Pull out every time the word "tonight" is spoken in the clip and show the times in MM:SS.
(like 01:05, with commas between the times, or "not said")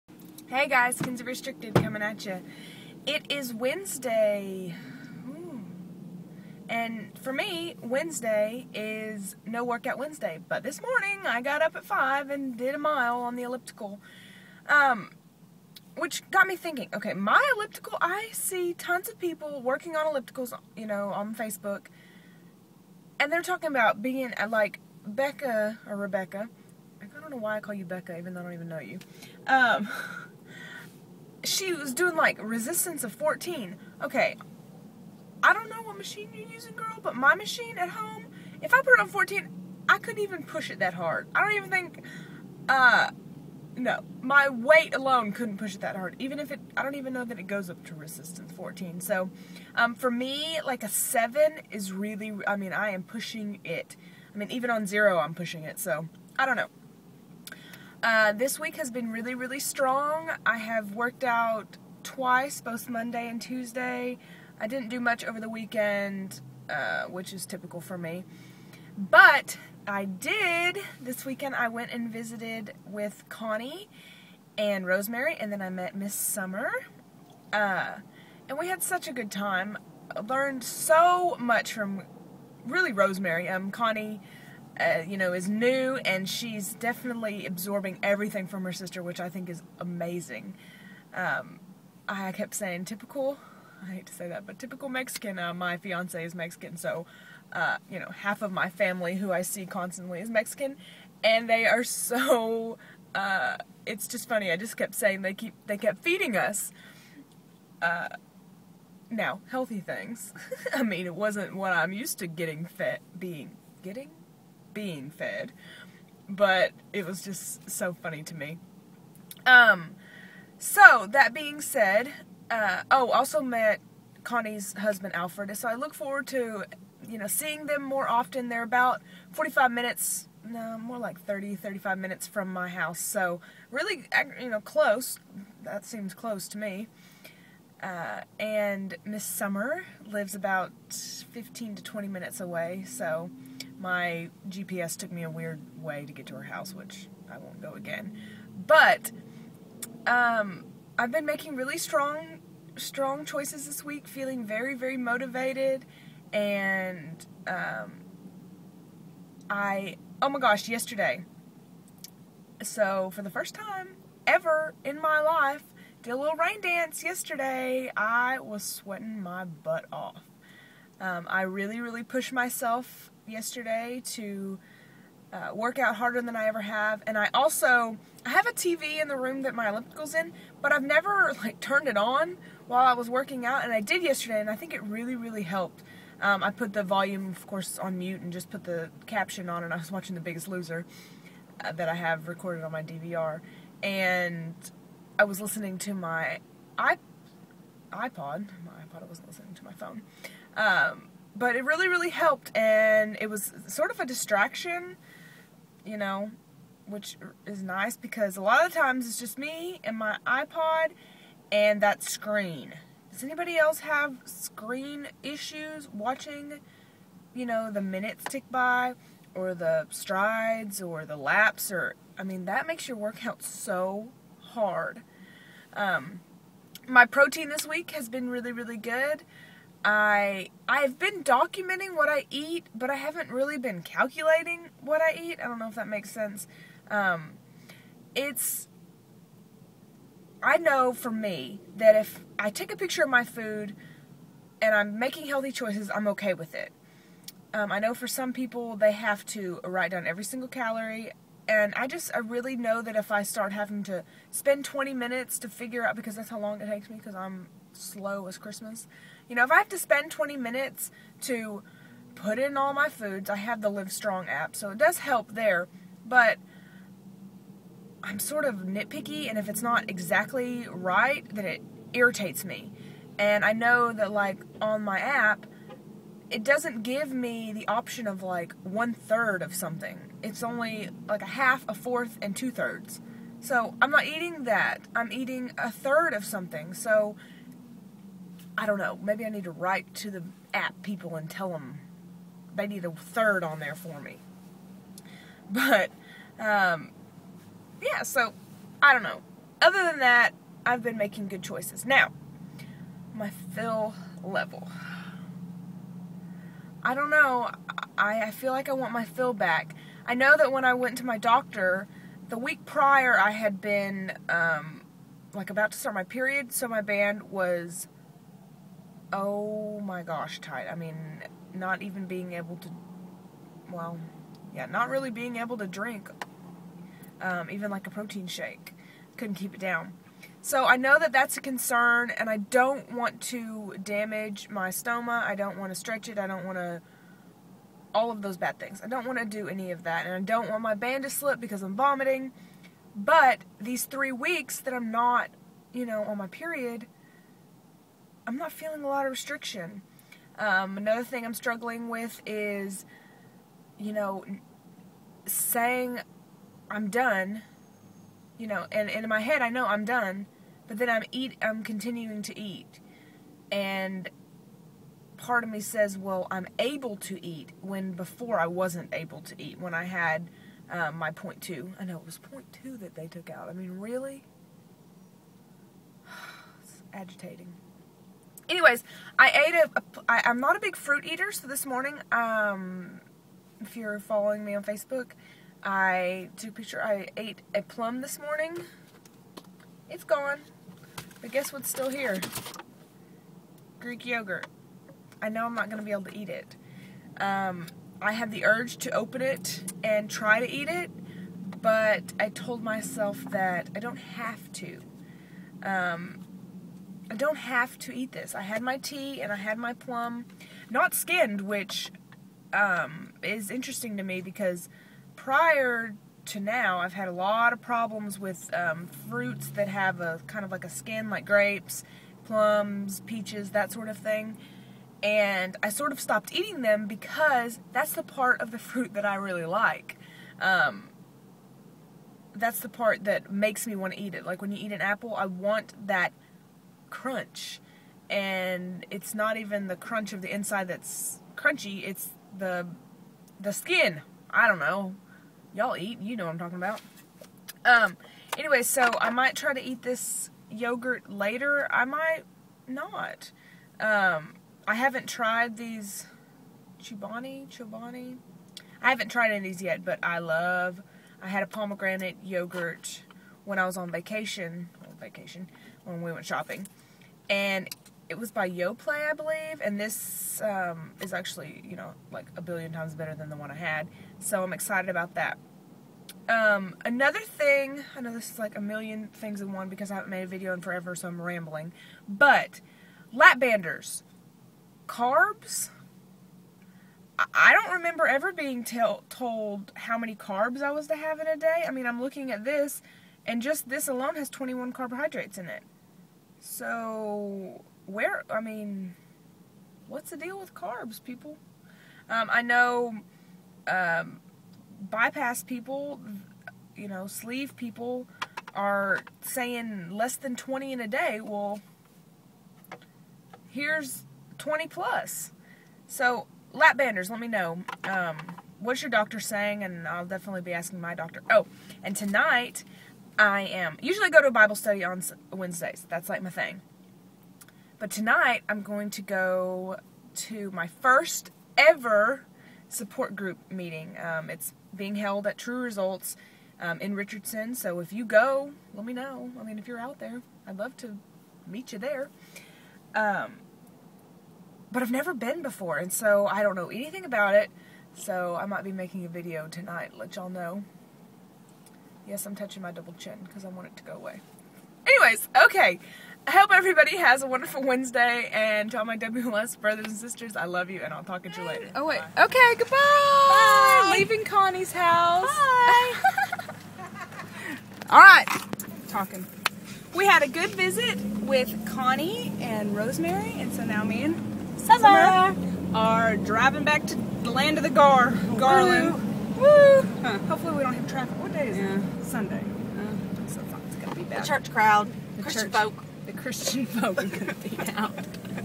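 08:41, 08:47, 09:09.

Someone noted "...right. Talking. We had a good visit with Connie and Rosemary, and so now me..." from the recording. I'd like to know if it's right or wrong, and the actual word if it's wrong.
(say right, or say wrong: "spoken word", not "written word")
right.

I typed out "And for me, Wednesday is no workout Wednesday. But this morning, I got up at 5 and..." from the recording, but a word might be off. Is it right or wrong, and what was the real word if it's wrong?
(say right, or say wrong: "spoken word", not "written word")
right.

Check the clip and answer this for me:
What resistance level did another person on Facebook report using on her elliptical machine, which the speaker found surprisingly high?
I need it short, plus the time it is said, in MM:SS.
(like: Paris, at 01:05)
14, at 00:32.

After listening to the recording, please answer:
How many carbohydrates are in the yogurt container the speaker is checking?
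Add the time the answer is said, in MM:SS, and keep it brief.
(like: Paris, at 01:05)
21, at 08:14.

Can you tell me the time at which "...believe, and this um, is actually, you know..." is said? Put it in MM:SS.
07:49.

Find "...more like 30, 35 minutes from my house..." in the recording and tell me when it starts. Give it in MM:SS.
02:10.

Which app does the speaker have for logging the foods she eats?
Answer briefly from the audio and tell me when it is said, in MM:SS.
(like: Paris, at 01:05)
Live Strong, at 04:23.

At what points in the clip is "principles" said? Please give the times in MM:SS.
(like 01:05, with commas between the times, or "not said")
not said.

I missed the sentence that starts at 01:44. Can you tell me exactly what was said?
I just kept saying they keep they kept feeding us.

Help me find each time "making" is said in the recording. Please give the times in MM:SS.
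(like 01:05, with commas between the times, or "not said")
02:31, 04:04, 05:00, 09:08.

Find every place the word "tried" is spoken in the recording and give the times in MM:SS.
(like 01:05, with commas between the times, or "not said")
07:35, 07:39.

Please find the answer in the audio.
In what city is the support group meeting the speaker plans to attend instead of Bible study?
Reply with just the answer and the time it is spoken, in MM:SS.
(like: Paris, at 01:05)
Richardson, at 08:56.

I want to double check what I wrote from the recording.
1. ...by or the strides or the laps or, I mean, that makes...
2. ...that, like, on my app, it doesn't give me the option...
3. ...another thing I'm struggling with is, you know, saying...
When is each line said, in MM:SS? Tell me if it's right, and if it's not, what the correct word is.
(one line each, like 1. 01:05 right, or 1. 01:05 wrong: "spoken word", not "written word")
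1. 03:38 right
2. 04:33 right
3. 05:50 right.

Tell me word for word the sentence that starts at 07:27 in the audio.
Um, anyway, so I might try to eat this yogurt later.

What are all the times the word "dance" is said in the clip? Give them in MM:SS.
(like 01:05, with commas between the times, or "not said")
02:46.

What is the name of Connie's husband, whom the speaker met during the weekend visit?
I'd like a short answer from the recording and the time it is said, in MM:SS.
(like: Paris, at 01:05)
Alfred, at 02:05.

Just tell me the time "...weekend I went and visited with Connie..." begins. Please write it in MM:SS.
01:11.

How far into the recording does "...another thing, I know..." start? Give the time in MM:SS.
07:56.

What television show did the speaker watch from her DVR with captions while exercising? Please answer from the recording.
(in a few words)
The Biggest Loser.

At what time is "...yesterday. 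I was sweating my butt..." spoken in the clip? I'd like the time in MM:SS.
02:47.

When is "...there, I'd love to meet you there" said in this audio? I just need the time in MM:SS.
08:59.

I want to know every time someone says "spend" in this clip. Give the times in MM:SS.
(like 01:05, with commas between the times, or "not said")
04:14, 04:19.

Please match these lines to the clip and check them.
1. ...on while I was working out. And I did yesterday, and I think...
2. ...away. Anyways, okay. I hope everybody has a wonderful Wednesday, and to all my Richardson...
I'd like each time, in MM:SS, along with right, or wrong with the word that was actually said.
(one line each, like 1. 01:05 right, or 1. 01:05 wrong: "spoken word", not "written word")
1. 03:01 right
2. 09:13 wrong: "WLS", not "Richardson".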